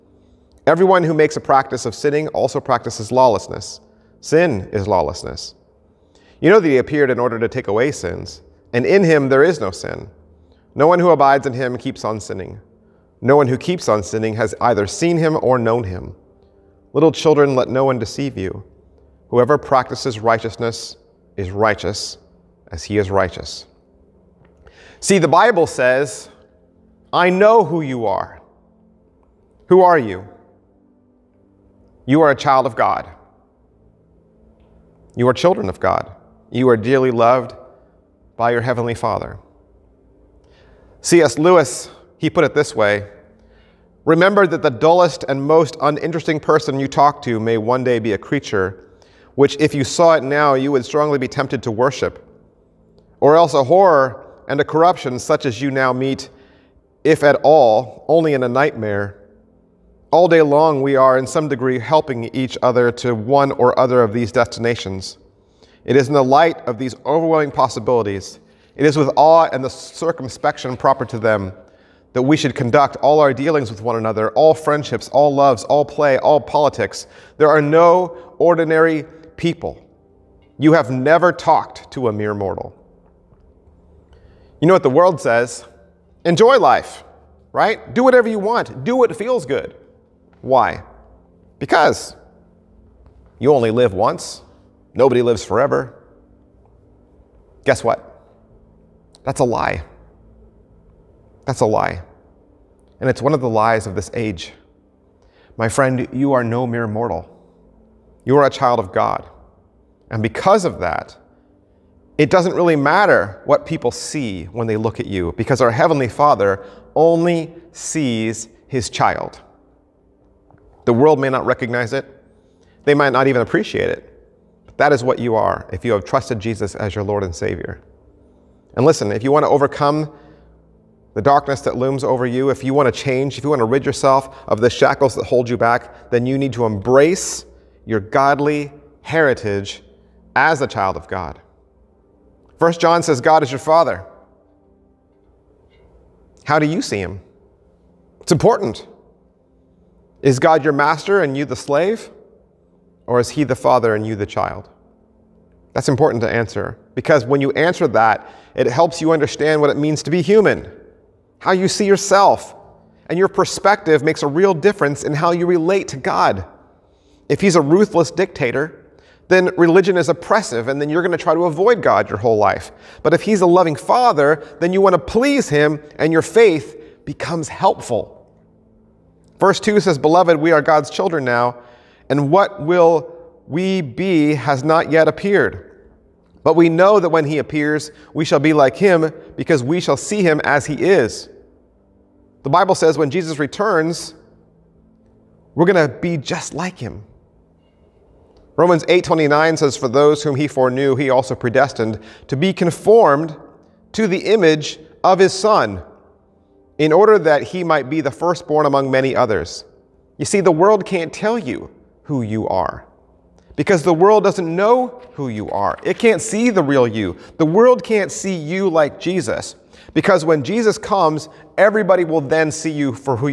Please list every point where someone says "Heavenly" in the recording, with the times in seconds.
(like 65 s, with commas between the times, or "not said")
38 s, 115 s.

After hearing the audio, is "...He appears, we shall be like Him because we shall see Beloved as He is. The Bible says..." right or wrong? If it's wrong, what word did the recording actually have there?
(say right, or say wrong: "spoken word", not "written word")
wrong: "Him", not "Beloved".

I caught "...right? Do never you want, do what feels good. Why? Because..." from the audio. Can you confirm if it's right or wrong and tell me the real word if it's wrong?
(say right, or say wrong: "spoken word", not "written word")
wrong: "whatever", not "never".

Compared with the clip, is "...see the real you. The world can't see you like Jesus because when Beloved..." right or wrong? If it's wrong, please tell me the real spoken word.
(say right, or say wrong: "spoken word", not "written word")
wrong: "Jesus", not "Beloved".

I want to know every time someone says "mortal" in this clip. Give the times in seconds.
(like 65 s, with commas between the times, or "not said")
82 s, 106 s.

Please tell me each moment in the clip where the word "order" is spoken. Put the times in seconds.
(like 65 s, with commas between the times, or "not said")
7 s, 206 s.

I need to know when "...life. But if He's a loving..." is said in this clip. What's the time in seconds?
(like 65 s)
172 s.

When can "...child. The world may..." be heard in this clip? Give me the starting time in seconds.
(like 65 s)
118 s.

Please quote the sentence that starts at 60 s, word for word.
All day long, we are in some degree helping each other to one or other of these destinations.